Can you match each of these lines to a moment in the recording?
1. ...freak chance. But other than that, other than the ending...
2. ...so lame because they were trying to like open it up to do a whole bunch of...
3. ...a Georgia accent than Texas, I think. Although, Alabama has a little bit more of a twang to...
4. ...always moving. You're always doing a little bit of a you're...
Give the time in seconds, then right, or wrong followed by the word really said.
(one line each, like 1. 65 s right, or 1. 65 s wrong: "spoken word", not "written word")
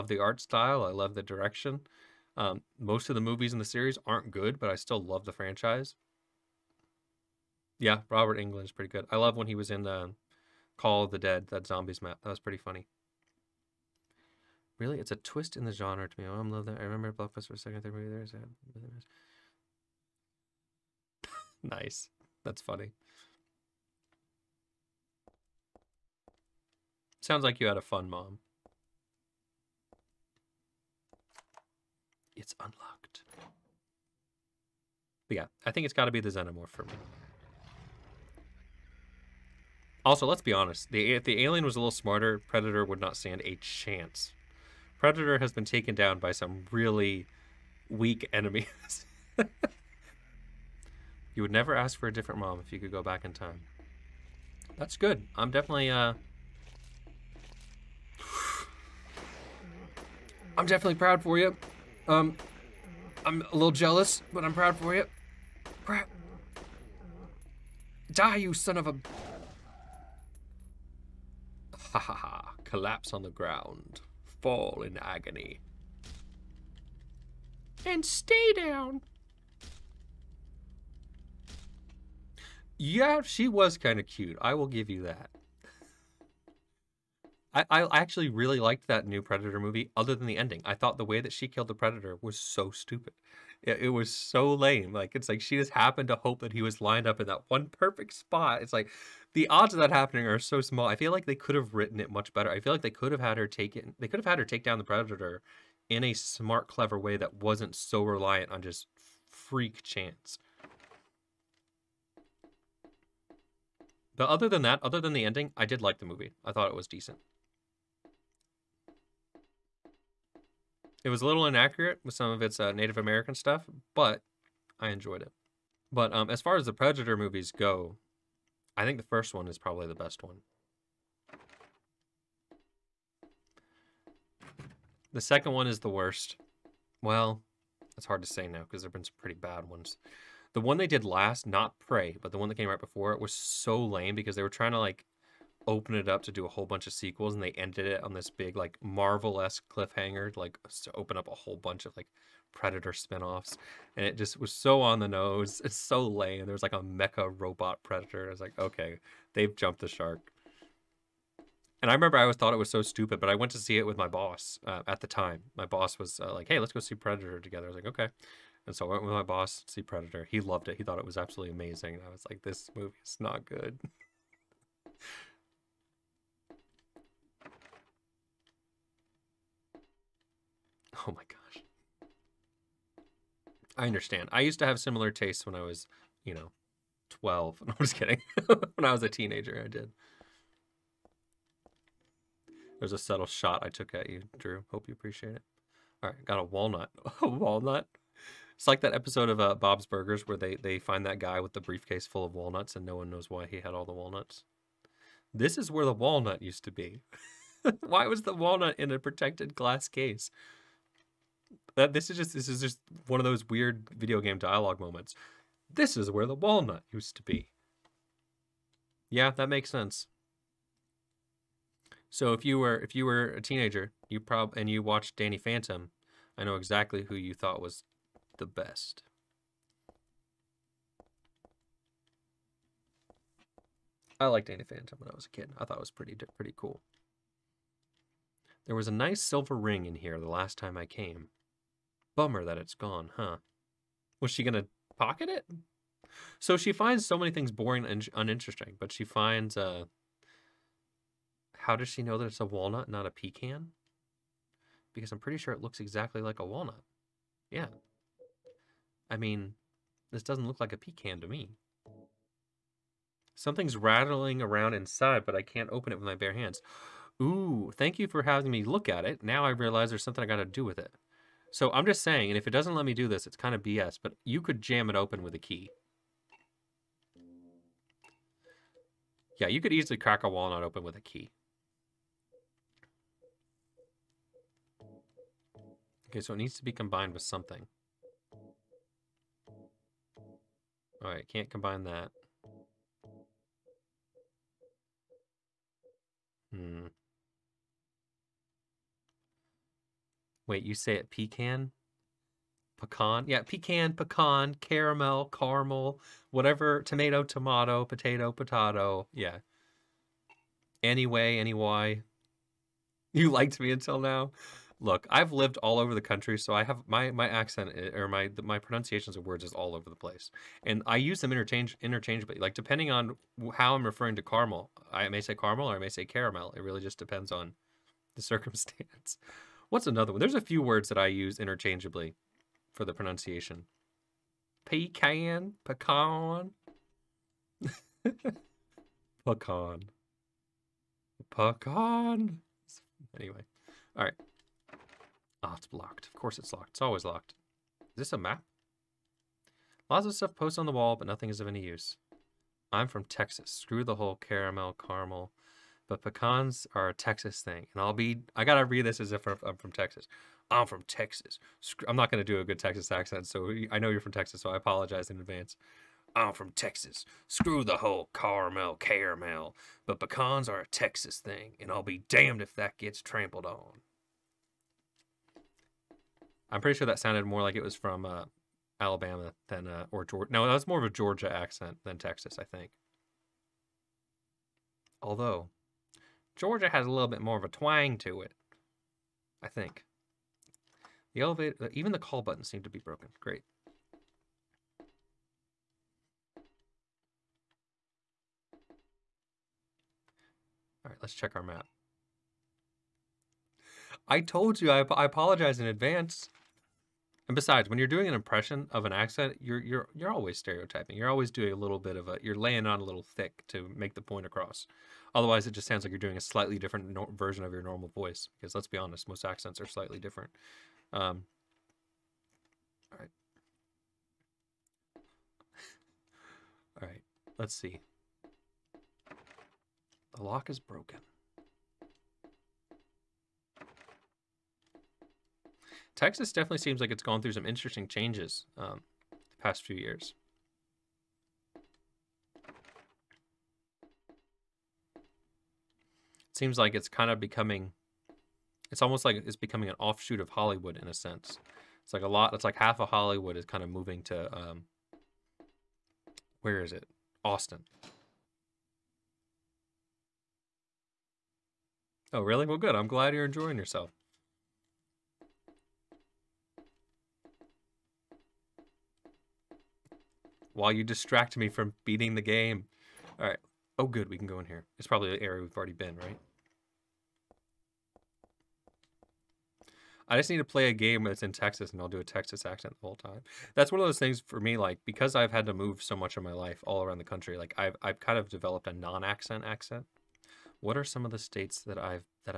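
1. 109 s right
2. 143 s right
3. 380 s wrong: "Georgia", not "Alabama"
4. 410 s wrong: "stereotyping", not "moving".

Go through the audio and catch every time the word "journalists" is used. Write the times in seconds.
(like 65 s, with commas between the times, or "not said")
not said.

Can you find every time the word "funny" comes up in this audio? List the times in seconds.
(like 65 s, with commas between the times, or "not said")
12 s, 22 s.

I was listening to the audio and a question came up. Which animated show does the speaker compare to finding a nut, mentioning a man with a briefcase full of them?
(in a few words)
Bob's Burgers.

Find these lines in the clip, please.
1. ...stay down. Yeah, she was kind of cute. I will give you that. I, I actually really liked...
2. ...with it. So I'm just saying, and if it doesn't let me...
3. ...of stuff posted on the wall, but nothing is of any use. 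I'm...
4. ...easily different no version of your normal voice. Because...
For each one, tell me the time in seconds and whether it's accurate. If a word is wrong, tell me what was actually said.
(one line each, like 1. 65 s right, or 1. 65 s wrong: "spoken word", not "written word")
1. 78 s right
2. 270 s right
3. 350 s right
4. 416 s wrong: "slightly", not "easily".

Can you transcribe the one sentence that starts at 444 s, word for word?
It seems like it's kind of becoming, it's almost like it's becoming an offshoot of Hollywood in a sense.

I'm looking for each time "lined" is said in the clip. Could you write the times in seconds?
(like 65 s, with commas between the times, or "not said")
96 s.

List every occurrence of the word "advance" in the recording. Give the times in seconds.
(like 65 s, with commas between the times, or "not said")
365 s, 405 s.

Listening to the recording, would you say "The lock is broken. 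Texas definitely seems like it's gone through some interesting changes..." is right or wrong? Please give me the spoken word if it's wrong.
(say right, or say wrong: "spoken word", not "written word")
right.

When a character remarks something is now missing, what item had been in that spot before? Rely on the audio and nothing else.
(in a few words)
silver ring.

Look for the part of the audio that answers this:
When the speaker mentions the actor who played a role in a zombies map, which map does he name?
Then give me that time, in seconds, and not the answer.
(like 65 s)
10 s.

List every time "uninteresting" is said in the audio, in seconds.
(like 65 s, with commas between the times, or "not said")
248 s.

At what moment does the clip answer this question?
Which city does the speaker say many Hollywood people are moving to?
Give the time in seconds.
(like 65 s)
457 s.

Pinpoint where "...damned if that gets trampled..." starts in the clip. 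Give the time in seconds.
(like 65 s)
372 s.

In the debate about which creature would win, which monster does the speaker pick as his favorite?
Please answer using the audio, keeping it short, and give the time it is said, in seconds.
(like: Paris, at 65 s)
xenomorph, at 36 s.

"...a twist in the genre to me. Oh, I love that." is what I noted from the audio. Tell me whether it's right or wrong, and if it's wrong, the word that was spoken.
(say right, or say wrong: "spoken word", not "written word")
right.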